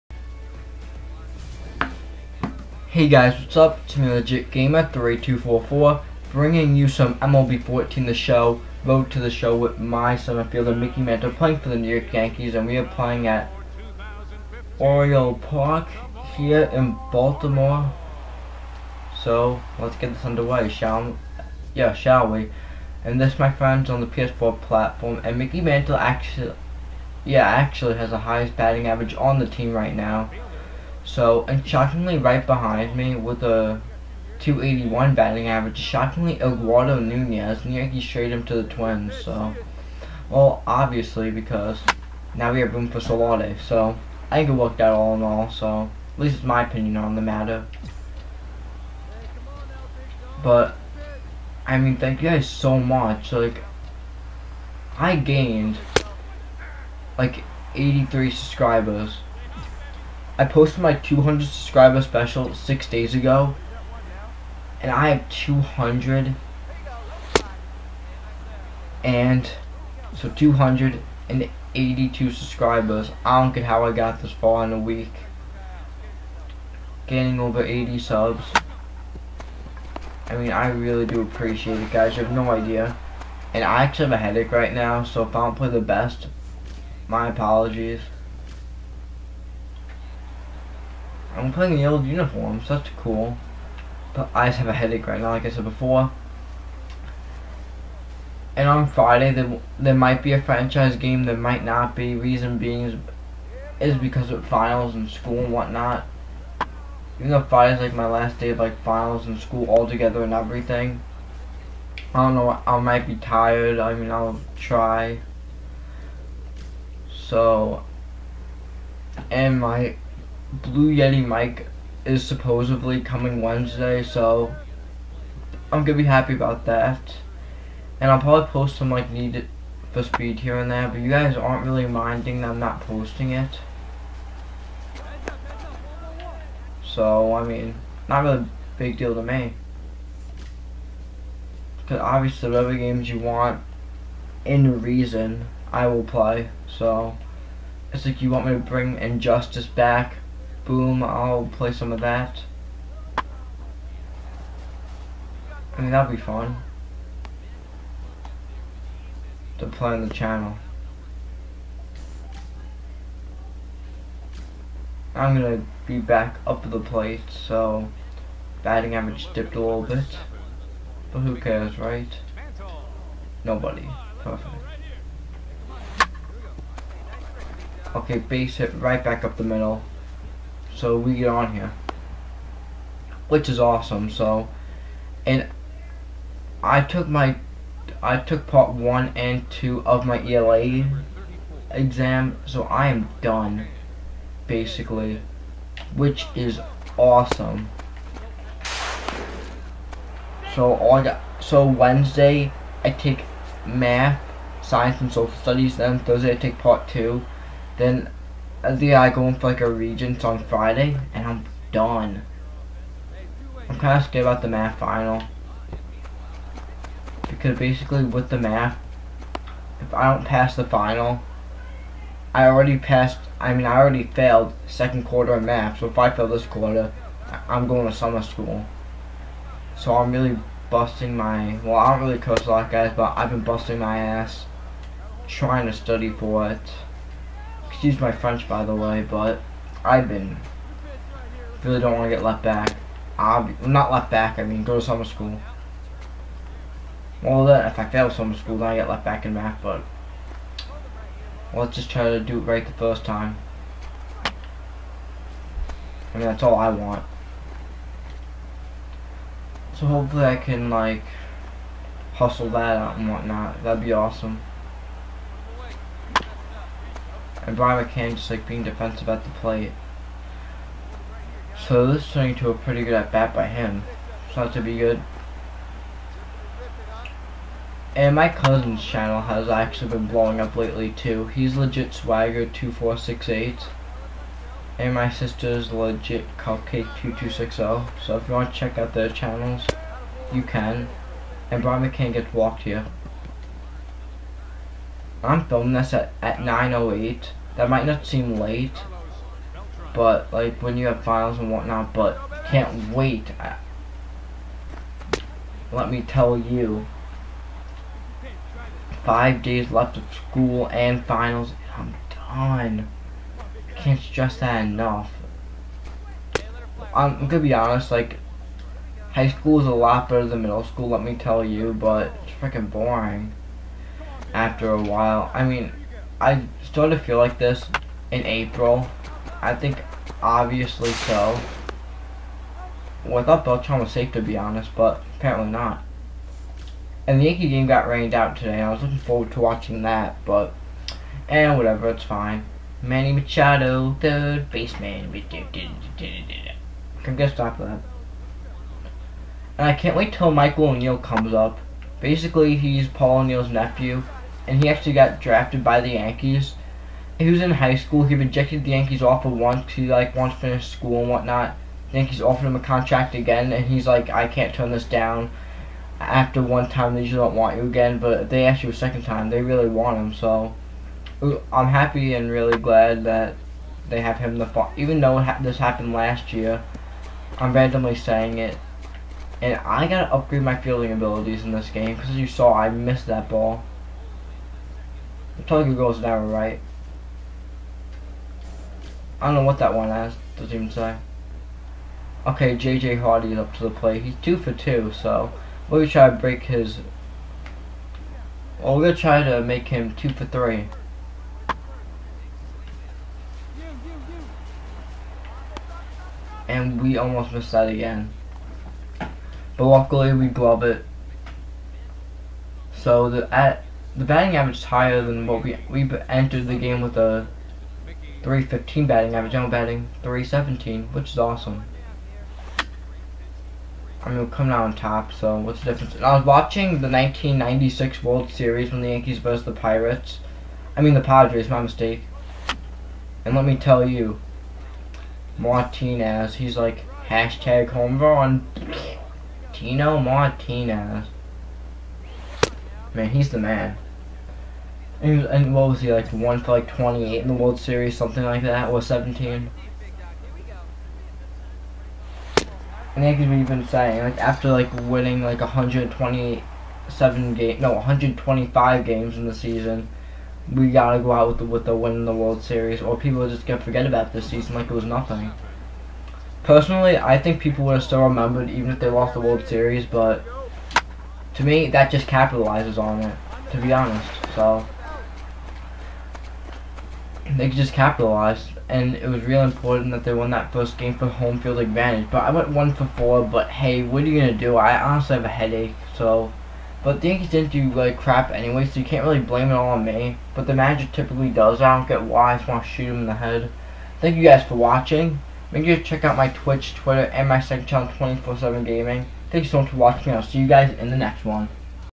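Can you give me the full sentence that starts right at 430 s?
I mean, the Padres, my mistake.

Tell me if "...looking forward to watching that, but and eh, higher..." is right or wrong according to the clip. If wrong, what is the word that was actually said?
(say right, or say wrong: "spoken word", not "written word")
wrong: "whatever", not "higher".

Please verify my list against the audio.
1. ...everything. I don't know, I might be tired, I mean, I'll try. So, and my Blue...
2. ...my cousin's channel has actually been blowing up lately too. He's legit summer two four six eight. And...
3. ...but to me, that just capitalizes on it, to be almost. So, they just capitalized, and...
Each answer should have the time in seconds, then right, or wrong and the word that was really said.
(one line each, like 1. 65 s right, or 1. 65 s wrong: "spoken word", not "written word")
1. 110 s right
2. 278 s wrong: "swagger", not "summer"
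3. 469 s wrong: "honest", not "almost".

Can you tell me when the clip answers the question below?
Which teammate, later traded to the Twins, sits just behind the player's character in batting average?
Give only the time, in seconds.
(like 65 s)
36 s.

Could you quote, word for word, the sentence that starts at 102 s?
Reason being is, is because of finals and school and whatnot.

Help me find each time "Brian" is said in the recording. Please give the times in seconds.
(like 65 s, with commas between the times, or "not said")
267 s, 291 s.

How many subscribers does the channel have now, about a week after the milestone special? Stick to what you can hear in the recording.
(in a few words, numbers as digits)
282.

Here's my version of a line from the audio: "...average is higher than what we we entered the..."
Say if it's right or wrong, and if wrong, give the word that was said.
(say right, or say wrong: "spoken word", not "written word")
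right.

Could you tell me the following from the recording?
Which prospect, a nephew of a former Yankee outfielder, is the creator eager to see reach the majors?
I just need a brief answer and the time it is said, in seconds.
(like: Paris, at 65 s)
Michael O'Neill, at 350 s.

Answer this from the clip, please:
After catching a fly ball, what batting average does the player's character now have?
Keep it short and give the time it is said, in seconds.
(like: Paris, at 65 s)
317, at 420 s.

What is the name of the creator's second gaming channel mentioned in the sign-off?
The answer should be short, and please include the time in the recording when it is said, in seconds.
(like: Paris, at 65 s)
24-7 Gaming, at 497 s.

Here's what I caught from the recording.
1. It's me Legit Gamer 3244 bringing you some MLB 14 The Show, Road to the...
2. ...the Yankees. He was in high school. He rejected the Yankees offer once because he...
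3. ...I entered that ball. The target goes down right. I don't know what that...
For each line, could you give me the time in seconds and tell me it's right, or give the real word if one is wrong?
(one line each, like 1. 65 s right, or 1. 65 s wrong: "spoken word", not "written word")
1. 3 s right
2. 355 s right
3. 382 s wrong: "missed", not "entered".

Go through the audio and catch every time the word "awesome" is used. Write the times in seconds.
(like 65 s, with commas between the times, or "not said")
183 s, 196 s, 263 s, 421 s.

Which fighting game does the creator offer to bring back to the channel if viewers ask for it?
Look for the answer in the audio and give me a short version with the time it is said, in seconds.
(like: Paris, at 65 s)
Injustice, at 148 s.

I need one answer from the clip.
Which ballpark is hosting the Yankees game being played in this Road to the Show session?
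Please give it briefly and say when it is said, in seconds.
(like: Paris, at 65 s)
Oriole Park, at 14 s.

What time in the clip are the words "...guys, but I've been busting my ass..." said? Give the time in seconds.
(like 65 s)
232 s.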